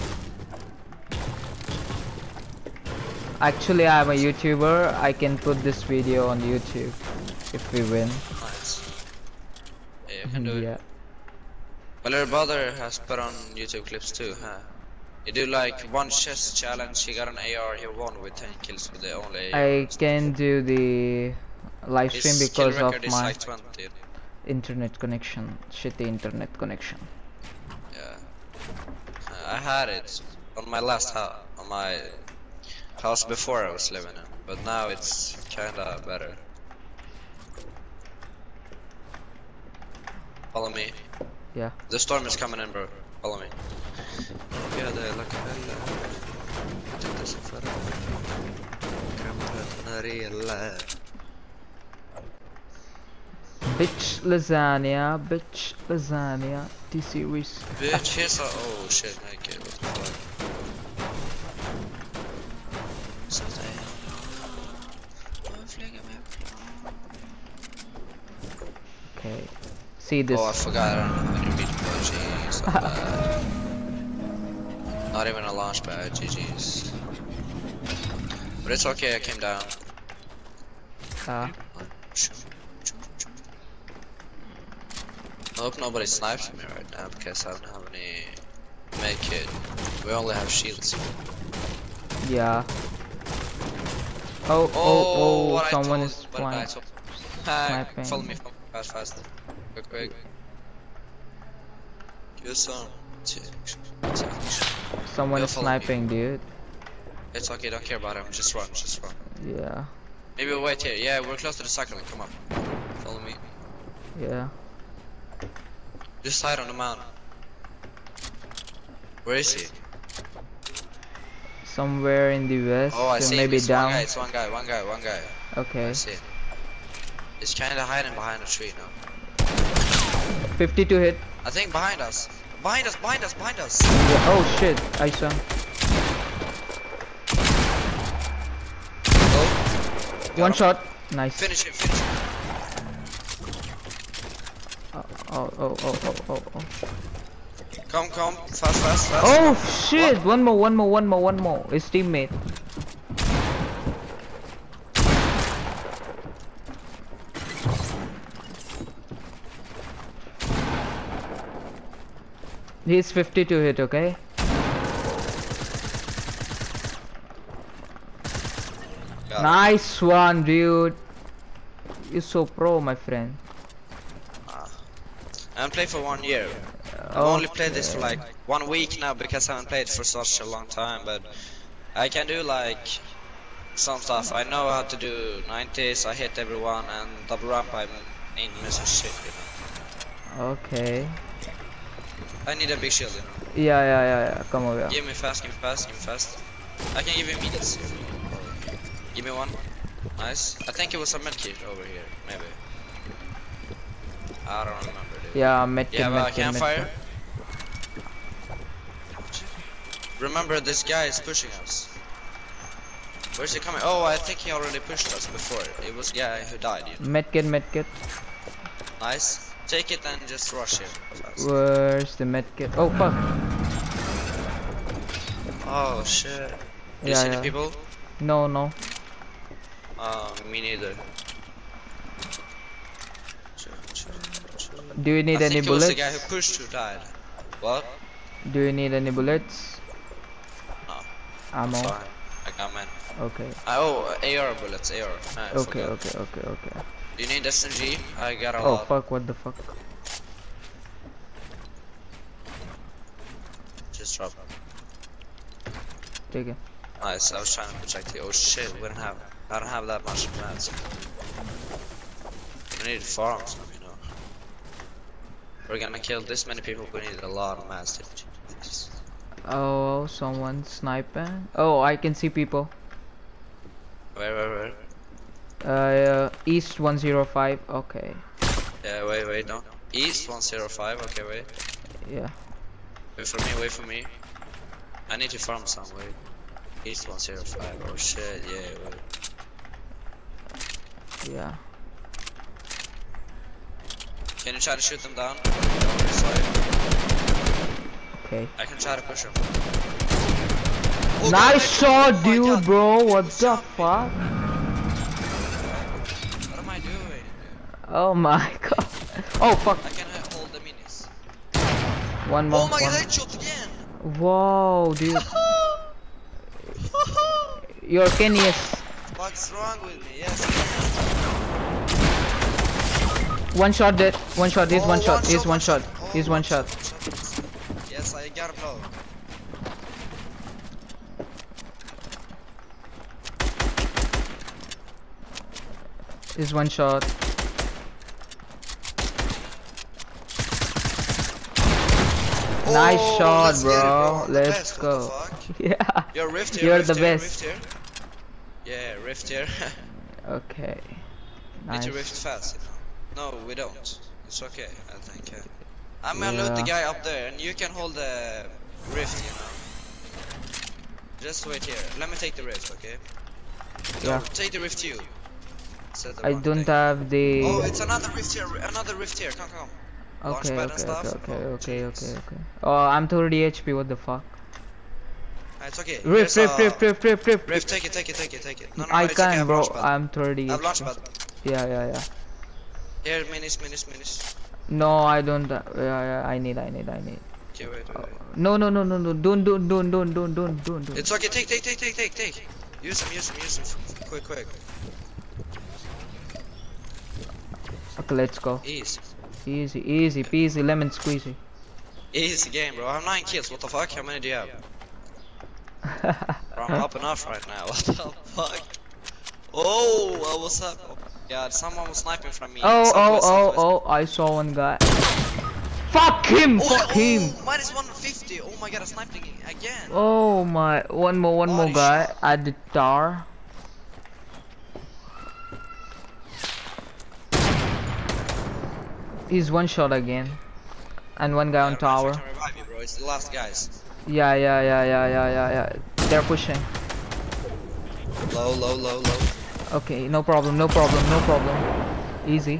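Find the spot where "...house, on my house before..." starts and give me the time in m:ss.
0:31.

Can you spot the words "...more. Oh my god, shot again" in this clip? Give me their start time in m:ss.
5:12.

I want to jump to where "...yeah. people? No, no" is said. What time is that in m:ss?
3:47.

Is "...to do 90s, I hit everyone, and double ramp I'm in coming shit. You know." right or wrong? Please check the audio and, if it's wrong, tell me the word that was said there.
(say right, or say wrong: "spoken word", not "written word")
wrong: "missing", not "coming".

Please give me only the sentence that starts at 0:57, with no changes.
Bitch, here's a oh shit, I get what the fuck.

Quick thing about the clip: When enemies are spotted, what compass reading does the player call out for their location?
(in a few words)
East 105.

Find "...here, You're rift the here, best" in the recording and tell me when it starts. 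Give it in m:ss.
5:46.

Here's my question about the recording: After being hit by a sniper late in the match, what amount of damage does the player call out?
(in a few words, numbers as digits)
Minus 150.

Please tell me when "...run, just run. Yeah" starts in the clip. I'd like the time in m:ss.
1:48.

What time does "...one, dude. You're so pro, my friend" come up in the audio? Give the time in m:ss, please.
2:49.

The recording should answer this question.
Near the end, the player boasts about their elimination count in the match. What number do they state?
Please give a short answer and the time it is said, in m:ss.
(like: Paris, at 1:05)
9, at 6:43.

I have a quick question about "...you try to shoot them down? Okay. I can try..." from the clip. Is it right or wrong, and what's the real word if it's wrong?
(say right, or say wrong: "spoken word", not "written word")
right.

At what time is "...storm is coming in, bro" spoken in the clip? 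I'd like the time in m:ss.
0:41.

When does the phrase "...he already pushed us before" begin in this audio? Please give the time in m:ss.
3:34.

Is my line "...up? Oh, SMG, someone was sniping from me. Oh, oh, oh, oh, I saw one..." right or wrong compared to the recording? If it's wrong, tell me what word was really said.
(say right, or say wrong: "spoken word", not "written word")
wrong: "God", not "SMG".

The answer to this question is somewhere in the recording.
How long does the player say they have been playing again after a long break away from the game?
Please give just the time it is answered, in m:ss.
2:58.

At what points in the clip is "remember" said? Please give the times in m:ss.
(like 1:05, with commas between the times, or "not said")
3:24, 3:30.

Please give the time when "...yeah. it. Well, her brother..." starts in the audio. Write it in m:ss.
0:10.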